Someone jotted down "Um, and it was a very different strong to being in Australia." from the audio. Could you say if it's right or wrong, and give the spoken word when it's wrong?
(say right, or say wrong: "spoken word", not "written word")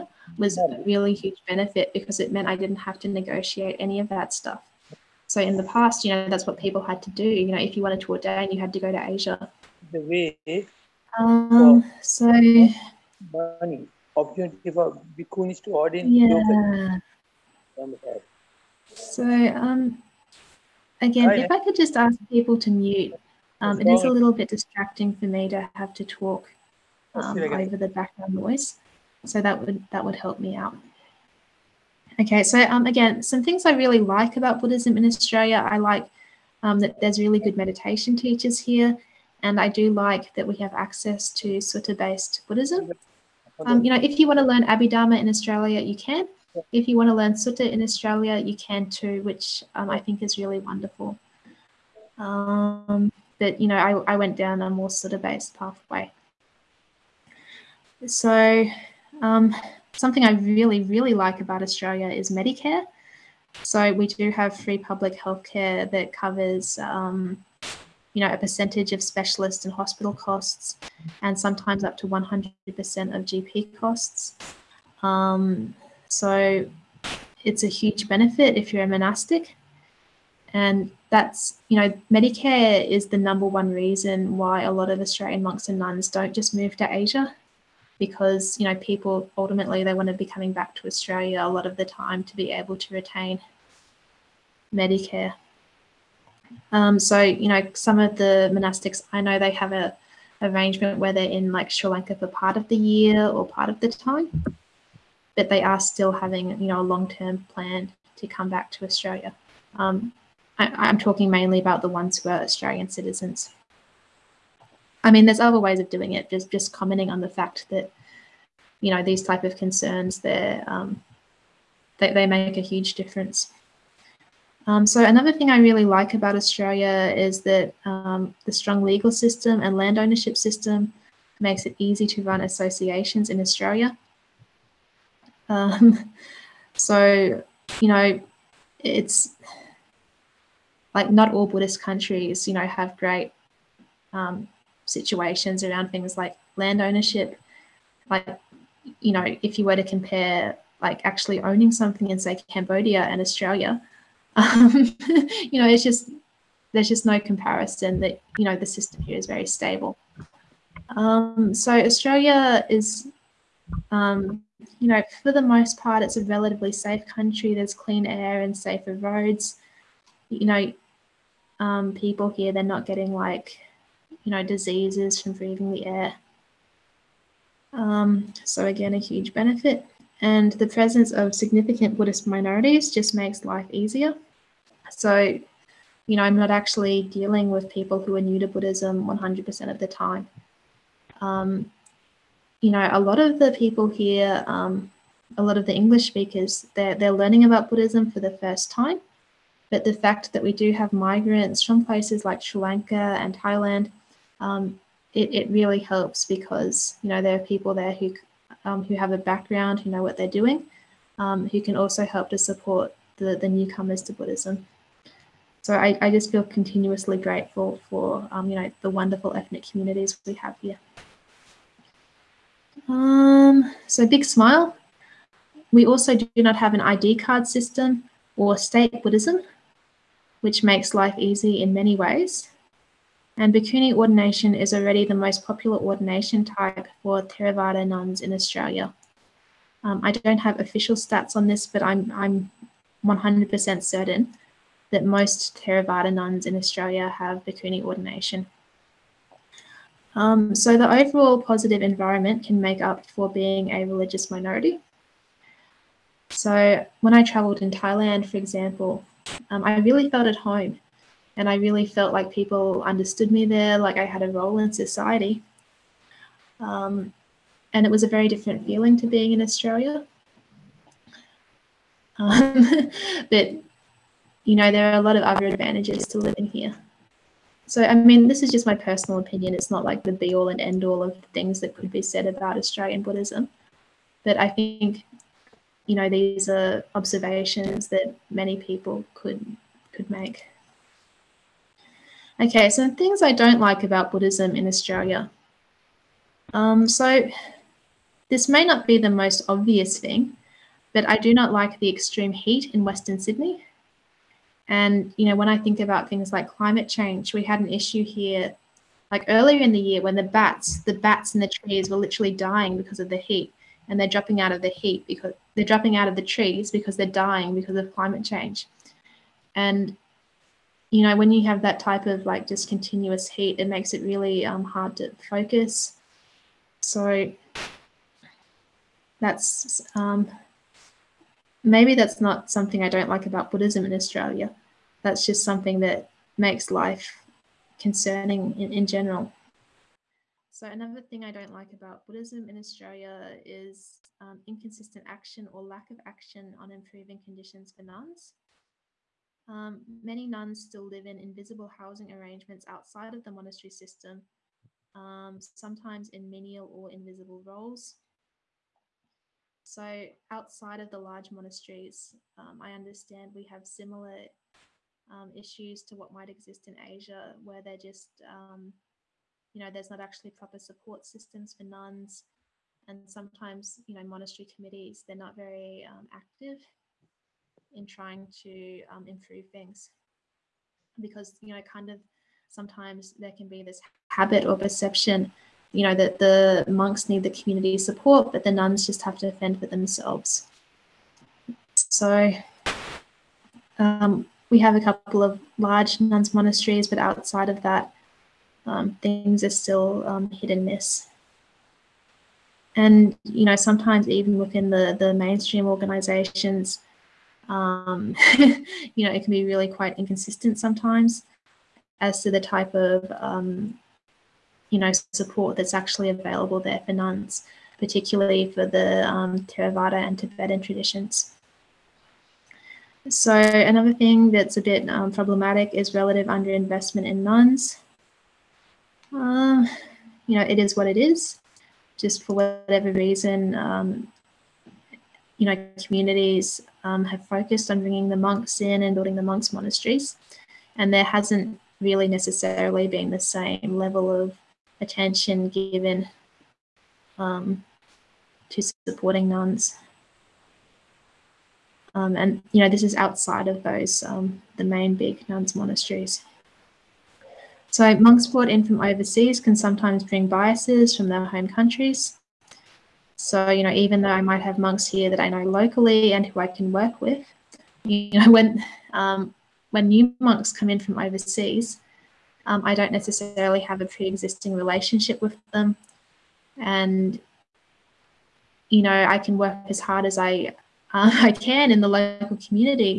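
wrong: "feeling", not "strong".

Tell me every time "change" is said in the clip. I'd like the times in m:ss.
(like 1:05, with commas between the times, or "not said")
5:06, 5:18.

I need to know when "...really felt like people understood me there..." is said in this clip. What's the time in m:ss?
4:21.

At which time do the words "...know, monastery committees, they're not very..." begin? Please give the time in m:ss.
6:13.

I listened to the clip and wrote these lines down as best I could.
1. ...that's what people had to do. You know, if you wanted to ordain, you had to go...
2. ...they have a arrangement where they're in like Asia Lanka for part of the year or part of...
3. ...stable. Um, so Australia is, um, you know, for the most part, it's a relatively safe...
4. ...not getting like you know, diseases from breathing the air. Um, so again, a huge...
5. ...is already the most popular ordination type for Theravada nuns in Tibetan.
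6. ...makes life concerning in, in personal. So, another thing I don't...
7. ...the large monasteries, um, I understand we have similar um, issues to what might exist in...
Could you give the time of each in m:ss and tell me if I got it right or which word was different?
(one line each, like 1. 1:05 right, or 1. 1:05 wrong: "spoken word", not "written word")
1. 0:06 right
2. 1:39 wrong: "Sri", not "Asia"
3. 2:39 right
4. 2:52 right
5. 3:54 wrong: "Australia", not "Tibetan"
6. 5:36 wrong: "general", not "personal"
7. 6:00 right.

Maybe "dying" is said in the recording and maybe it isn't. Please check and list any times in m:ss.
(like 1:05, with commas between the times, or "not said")
5:12, 5:17.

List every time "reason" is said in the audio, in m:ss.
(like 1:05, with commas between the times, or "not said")
1:23, 7:12.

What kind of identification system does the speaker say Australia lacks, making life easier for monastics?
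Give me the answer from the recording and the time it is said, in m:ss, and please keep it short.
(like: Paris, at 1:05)
ID card system, at 3:46.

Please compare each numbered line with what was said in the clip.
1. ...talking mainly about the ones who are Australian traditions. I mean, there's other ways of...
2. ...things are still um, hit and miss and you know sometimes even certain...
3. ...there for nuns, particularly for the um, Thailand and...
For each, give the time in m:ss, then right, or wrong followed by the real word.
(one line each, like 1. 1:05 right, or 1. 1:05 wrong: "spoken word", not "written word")
1. 1:50 wrong: "citizens", not "traditions"
2. 6:39 wrong: "within", not "certain"
3. 6:56 wrong: "Theravada", not "Thailand".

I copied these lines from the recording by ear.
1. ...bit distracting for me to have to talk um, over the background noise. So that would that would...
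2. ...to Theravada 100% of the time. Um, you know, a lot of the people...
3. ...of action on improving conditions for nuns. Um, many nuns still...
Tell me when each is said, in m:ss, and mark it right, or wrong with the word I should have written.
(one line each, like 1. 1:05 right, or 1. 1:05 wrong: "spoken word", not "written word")
1. 0:24 right
2. 3:08 wrong: "Buddhism", not "Theravada"
3. 5:45 right.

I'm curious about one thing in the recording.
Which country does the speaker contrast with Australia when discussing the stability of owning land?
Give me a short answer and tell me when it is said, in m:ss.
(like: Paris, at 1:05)
Cambodia, at 2:32.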